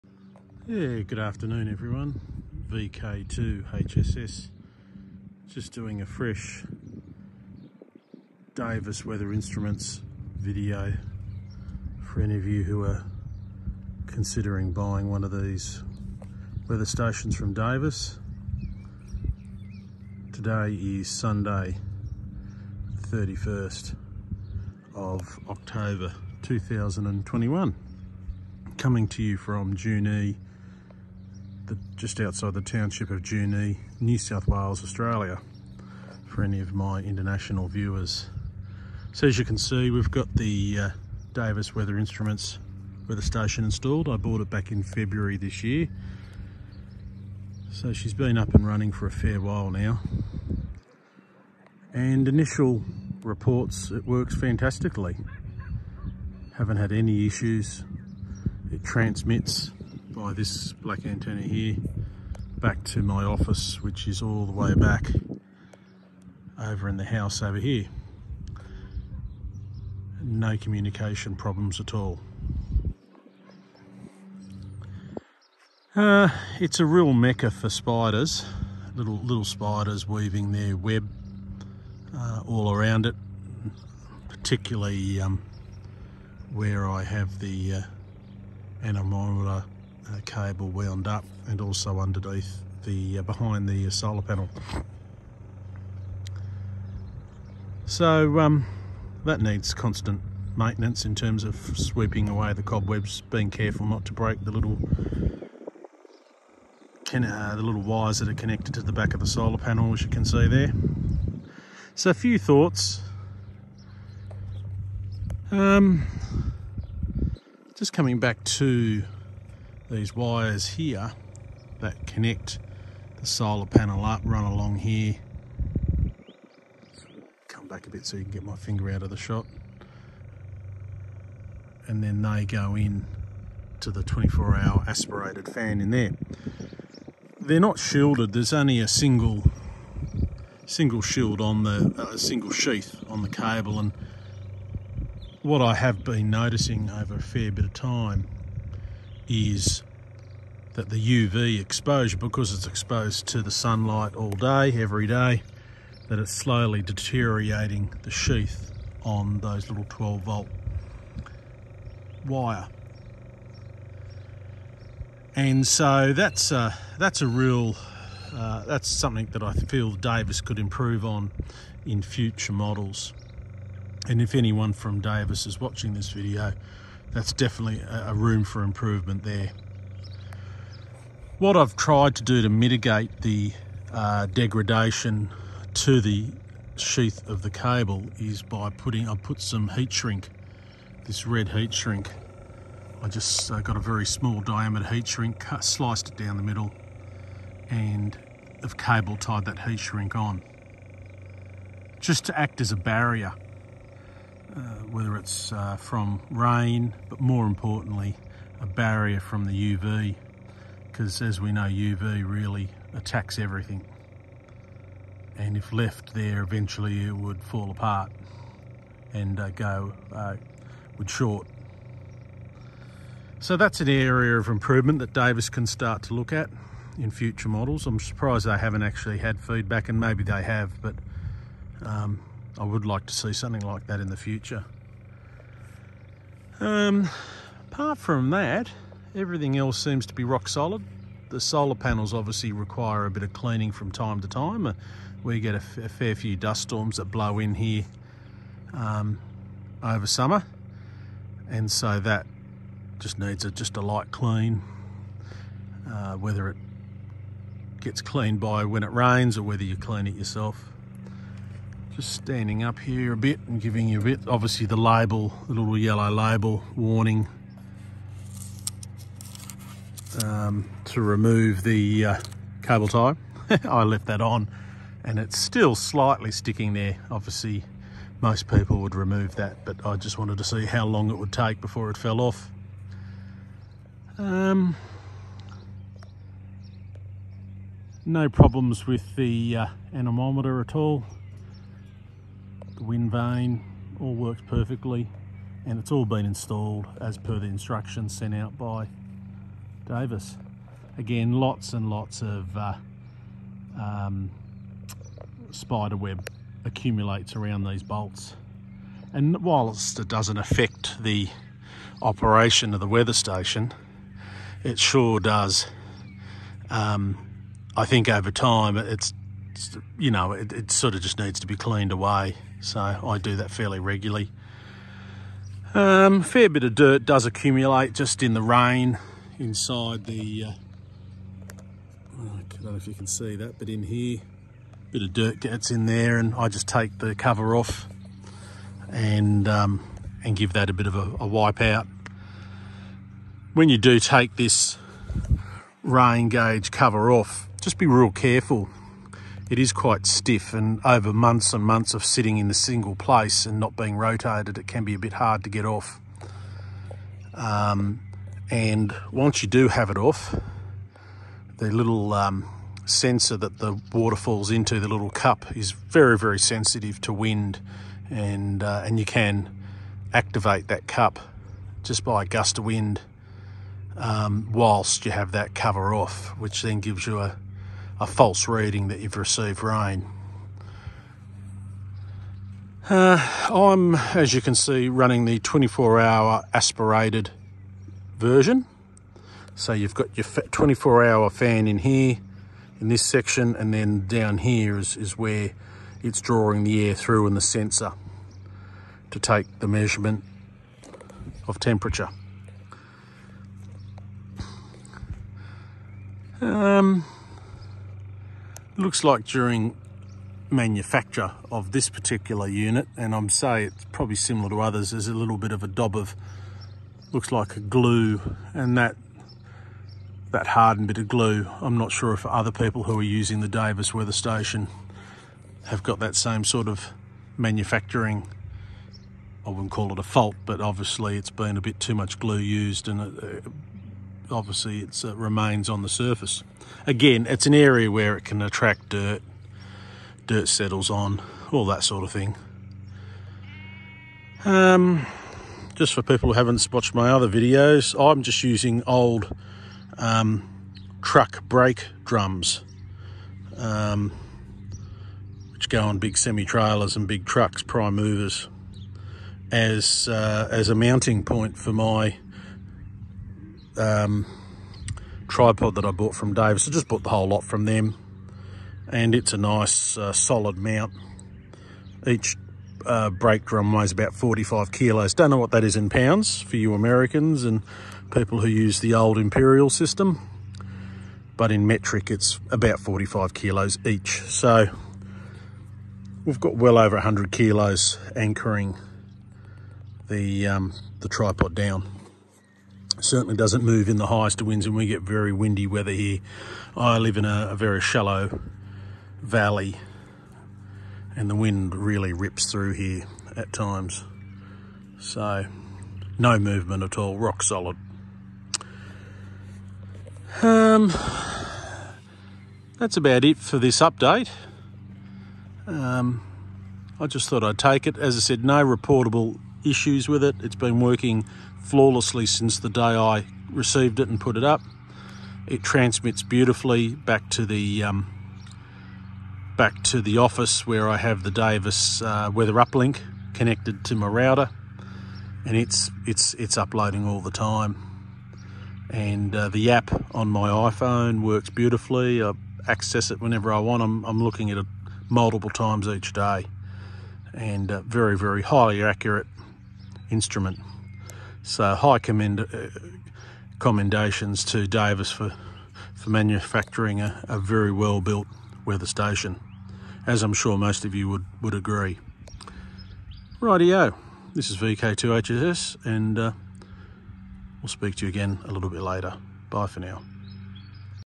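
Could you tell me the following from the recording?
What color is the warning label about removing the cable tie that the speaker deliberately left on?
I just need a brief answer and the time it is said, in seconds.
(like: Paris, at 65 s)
Yellow, at 265 s.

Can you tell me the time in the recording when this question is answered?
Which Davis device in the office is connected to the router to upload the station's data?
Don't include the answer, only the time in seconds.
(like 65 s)
532 s.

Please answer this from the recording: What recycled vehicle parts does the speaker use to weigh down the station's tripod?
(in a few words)
Truck brake drums.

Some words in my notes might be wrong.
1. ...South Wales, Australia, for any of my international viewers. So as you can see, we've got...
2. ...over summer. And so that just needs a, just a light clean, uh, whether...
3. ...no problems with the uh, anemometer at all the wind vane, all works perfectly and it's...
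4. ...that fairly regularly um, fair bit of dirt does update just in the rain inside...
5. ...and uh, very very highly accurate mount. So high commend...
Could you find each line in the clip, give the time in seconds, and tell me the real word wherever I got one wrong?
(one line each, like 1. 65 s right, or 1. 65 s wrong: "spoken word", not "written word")
1. 34 s right
2. 249 s right
3. 288 s right
4. 323 s wrong: "accumulate", not "update"
5. 547 s wrong: "instrument", not "mount".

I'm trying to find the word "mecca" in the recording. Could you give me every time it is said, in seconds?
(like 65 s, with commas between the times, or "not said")
77 s.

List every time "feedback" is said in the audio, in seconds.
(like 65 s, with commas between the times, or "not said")
229 s.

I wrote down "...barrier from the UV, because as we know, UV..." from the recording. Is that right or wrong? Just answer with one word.
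right.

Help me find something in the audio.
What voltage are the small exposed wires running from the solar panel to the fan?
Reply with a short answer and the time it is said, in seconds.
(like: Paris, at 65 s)
12 volt, at 159 s.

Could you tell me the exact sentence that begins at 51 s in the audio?
And initial reports, it works fantastically.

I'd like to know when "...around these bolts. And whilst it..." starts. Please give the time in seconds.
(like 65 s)
307 s.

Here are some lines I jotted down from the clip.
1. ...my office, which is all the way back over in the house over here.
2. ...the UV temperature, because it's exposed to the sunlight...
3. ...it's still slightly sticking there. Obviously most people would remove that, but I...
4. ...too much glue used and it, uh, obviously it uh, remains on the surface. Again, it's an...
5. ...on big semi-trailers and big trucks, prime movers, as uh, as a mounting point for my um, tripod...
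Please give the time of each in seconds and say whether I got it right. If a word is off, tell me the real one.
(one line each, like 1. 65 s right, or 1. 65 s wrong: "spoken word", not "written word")
1. 63 s right
2. 150 s wrong: "exposure", not "temperature"
3. 275 s right
4. 431 s right
5. 455 s right.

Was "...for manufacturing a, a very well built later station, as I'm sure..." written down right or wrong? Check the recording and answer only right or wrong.
wrong.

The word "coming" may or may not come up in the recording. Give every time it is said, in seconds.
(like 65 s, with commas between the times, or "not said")
28 s, 117 s.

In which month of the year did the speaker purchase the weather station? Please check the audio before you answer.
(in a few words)
February.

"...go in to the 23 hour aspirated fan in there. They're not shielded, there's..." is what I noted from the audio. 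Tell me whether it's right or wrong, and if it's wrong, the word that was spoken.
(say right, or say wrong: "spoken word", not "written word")
wrong: "24", not "23".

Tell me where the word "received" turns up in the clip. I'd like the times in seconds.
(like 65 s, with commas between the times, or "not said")
379 s, 523 s.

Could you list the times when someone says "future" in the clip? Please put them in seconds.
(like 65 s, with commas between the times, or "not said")
172 s, 227 s, 234 s.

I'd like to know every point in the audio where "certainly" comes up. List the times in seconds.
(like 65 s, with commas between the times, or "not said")
493 s.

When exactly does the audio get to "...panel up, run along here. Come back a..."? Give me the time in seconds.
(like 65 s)
123 s.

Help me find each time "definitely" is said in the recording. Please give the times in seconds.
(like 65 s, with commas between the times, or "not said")
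177 s.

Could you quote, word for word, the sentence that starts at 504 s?
So no movement at all, rock solid.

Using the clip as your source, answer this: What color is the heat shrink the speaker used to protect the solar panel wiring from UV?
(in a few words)
Red.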